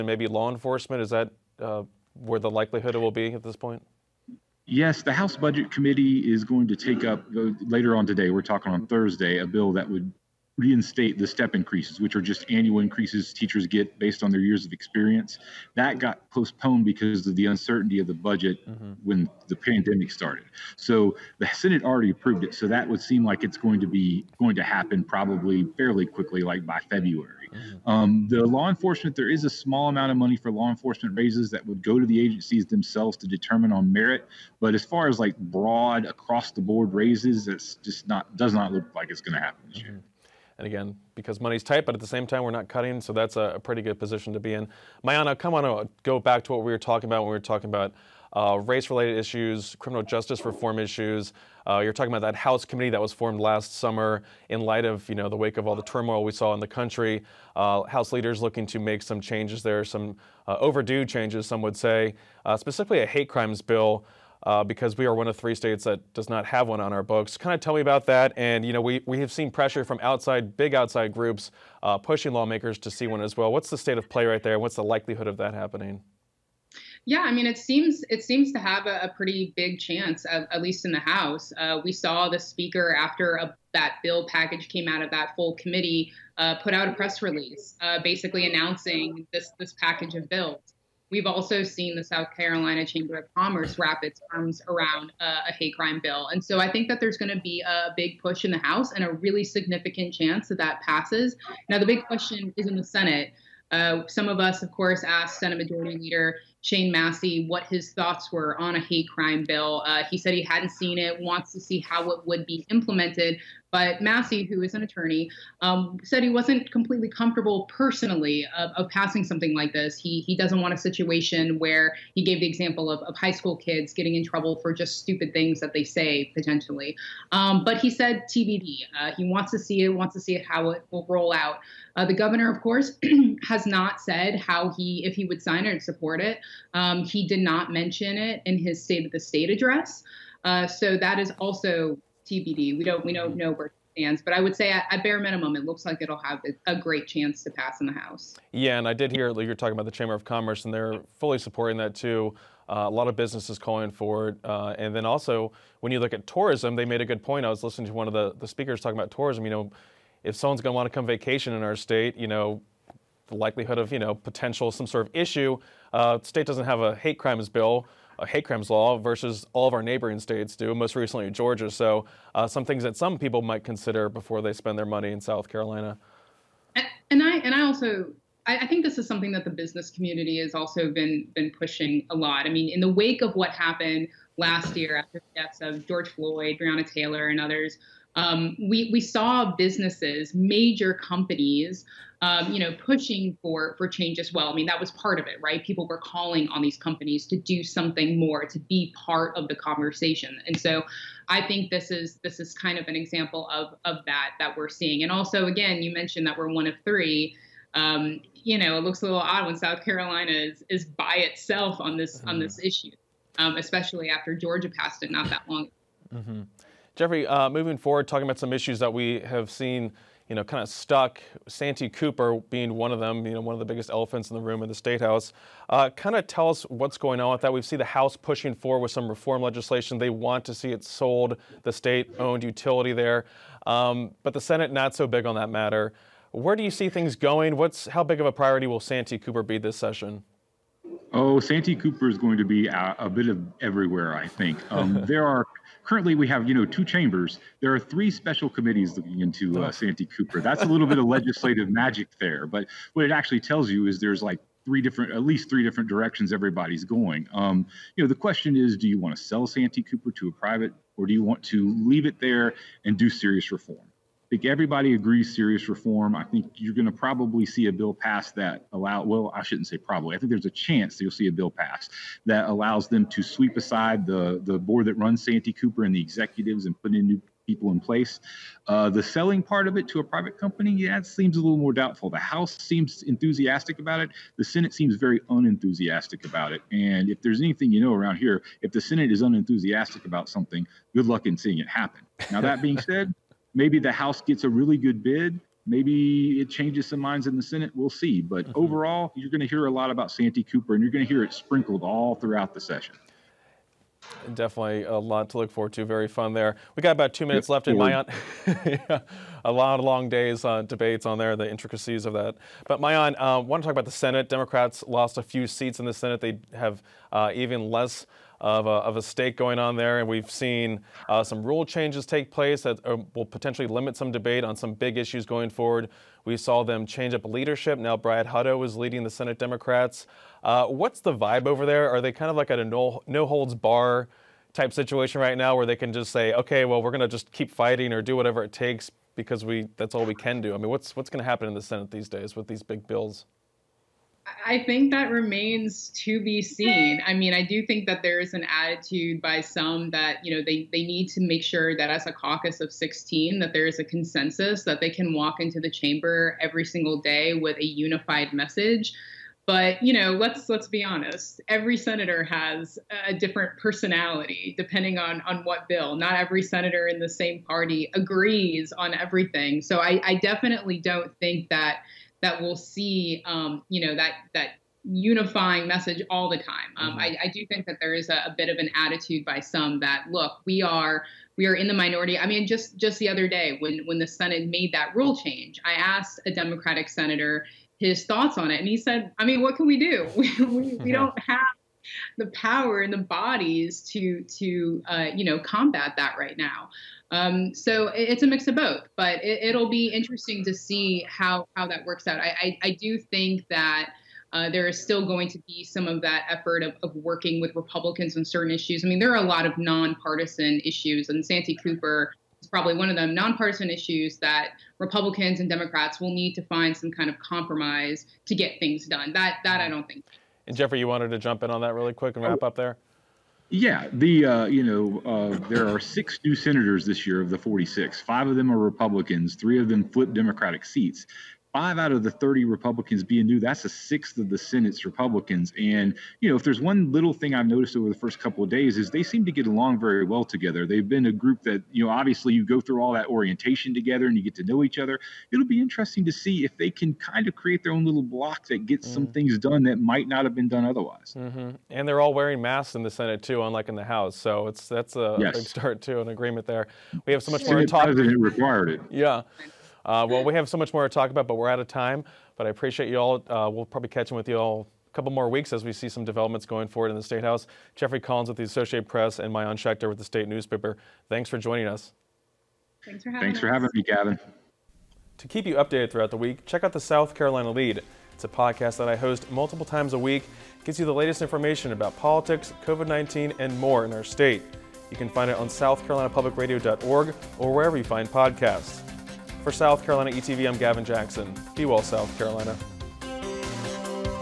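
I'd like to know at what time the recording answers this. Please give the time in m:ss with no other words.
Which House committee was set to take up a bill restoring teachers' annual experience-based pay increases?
0:05.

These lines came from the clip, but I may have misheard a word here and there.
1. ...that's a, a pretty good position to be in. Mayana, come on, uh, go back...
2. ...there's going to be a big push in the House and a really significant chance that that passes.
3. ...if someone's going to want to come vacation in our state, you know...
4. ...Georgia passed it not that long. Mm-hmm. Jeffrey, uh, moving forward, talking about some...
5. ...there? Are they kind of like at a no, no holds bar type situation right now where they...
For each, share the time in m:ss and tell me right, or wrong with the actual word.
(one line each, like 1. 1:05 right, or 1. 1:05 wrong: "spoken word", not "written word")
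1. 0:43 right
2. 1:36 right
3. 2:40 right
4. 3:34 right
5. 5:31 right.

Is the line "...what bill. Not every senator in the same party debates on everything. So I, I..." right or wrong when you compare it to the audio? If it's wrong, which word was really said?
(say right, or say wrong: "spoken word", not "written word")
wrong: "agrees", not "debates".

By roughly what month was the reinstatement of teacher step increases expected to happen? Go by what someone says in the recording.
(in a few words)
February.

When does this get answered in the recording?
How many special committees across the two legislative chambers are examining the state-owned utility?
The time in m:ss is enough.
4:07.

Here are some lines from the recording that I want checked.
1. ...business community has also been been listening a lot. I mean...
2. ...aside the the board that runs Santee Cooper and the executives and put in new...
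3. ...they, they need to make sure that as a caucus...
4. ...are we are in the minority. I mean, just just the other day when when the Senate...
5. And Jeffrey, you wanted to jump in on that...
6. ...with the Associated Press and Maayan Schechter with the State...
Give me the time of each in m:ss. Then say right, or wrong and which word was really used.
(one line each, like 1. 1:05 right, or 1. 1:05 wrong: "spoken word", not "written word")
1. 2:59 wrong: "pushing", not "listening"
2. 4:33 right
3. 5:50 right
4. 6:20 right
5. 7:00 right
6. 7:48 right.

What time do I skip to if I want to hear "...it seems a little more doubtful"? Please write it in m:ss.
4:40.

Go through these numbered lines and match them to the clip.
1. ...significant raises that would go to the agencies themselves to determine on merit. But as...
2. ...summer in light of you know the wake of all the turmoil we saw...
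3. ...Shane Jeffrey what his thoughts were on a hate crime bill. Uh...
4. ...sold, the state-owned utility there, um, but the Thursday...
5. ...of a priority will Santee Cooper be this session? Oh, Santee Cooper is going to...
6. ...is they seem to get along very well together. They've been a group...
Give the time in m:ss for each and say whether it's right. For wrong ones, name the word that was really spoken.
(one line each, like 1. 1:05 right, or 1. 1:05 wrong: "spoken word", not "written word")
1. 0:30 wrong: "enforcement", not "significant"
2. 0:53 right
3. 1:46 wrong: "Massey", not "Jeffrey"
4. 3:50 wrong: "Senate", not "Thursday"
5. 3:58 right
6. 7:18 right.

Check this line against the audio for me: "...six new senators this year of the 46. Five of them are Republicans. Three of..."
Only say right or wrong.
right.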